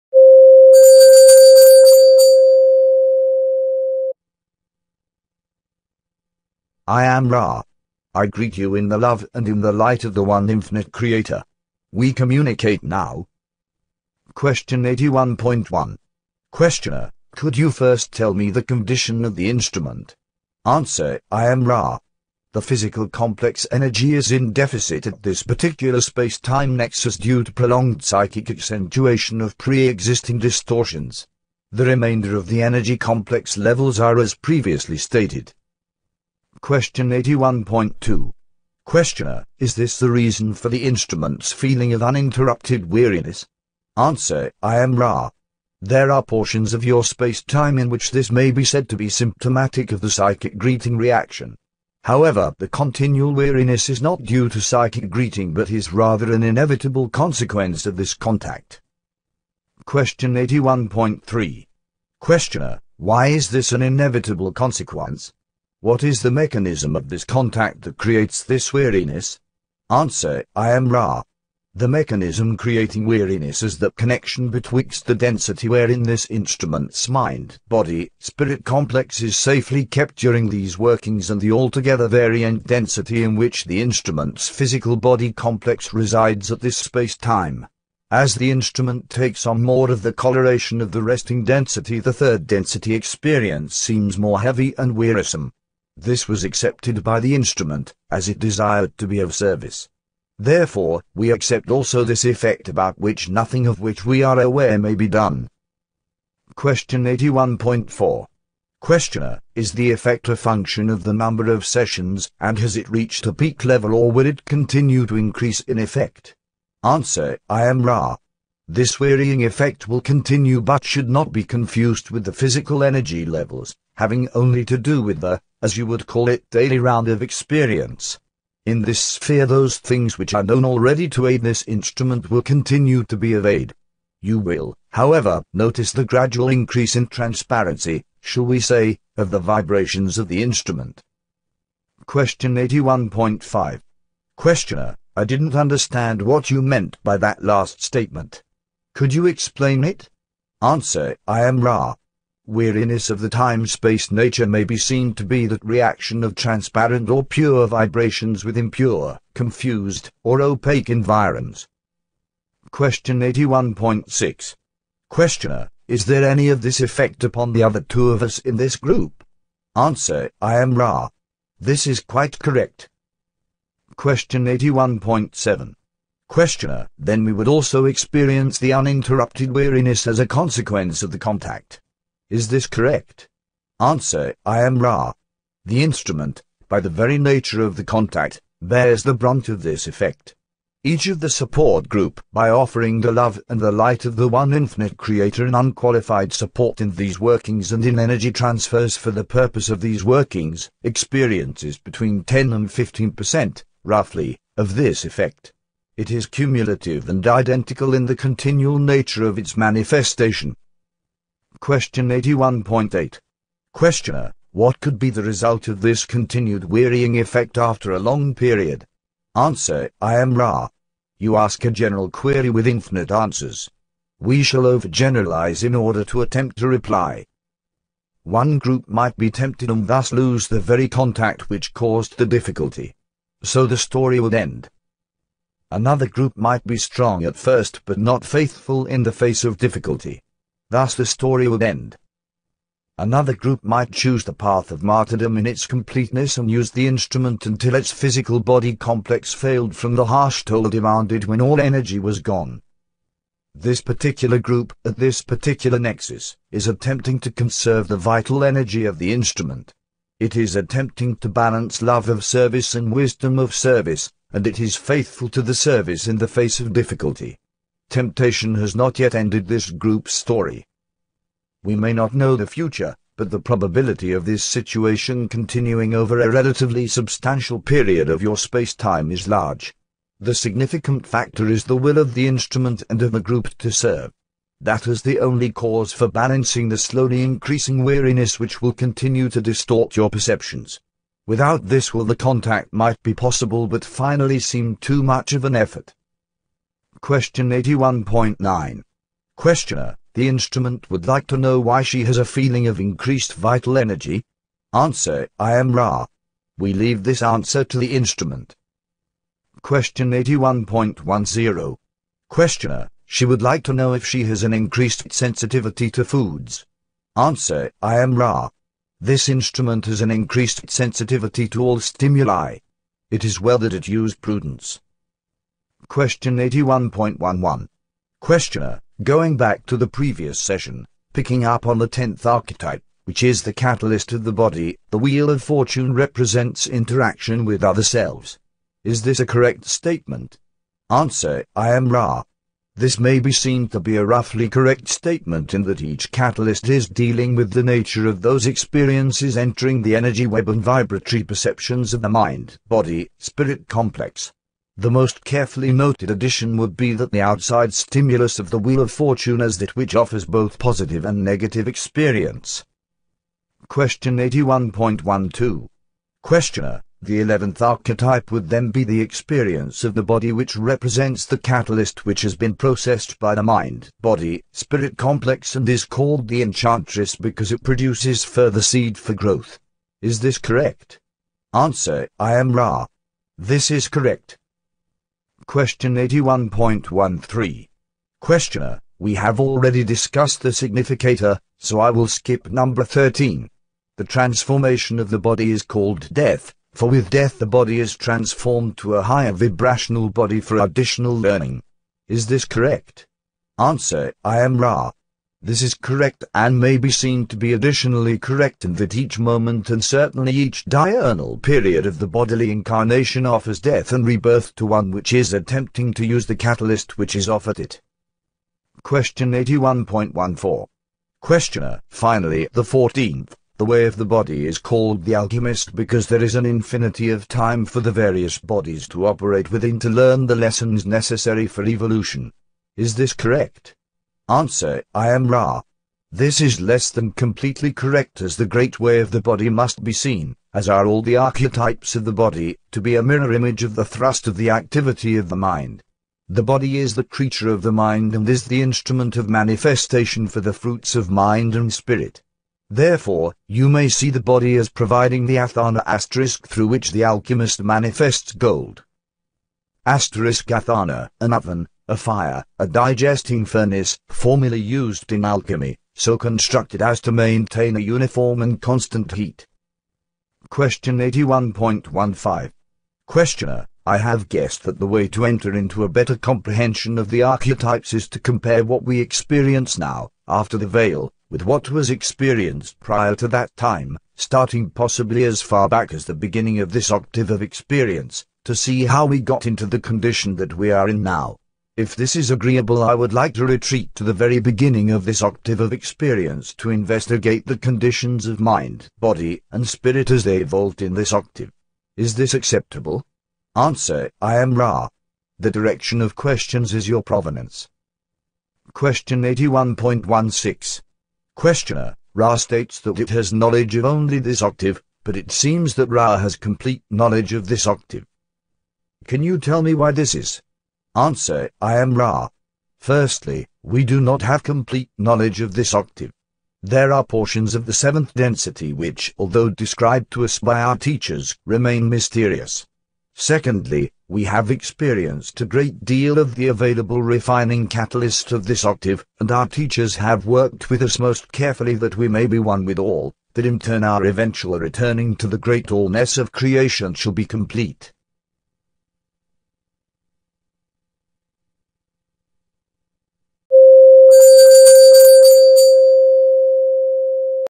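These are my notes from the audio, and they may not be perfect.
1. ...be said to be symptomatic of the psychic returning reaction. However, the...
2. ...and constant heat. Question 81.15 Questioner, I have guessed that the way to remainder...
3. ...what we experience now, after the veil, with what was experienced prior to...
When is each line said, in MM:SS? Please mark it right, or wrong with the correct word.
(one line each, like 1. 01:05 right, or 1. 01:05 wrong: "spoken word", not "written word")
1. 00:48 wrong: "greeting", not "returning"
2. 07:48 wrong: "enter", not "remainder"
3. 07:58 right.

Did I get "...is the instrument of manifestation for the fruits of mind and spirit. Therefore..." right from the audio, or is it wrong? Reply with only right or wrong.
right.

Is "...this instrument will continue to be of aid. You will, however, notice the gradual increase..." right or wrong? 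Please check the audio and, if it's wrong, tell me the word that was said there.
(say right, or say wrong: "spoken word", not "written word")
right.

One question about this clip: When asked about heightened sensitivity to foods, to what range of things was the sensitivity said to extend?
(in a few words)
all stimuli.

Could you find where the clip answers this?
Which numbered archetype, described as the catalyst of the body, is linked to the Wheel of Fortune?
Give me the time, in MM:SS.
05:31.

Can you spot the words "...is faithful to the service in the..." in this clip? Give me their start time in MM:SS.
04:24.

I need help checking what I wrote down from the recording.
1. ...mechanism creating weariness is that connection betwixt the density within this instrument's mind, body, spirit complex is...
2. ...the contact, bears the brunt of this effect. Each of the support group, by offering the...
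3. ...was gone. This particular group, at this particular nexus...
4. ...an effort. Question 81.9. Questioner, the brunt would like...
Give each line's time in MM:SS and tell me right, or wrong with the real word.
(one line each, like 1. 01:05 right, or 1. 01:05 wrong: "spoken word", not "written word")
1. 01:11 wrong: "wherein", not "within"
2. 03:07 right
3. 04:11 right
4. 04:55 wrong: "instrument", not "brunt".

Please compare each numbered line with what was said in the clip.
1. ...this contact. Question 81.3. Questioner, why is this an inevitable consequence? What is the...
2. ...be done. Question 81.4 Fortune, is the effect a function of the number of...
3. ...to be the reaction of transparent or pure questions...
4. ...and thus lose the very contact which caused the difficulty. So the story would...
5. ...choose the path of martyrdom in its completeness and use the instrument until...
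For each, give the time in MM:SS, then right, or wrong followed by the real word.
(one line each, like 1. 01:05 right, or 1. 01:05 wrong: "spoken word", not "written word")
1. 00:57 right
2. 01:44 wrong: "Questioner", not "Fortune"
3. 02:35 wrong: "vibrations", not "questions"
4. 03:49 right
5. 04:03 right.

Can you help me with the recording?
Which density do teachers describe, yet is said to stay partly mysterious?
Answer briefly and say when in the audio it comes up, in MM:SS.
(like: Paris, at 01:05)
seventh density, at 08:47.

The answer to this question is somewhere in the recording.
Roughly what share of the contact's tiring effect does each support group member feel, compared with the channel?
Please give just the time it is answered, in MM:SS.
03:21.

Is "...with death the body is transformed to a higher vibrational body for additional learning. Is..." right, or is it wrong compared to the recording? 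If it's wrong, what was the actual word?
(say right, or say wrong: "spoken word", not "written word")
right.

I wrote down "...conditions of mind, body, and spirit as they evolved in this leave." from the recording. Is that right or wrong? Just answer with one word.
wrong.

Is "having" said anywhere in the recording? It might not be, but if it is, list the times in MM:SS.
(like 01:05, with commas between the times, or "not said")
02:03.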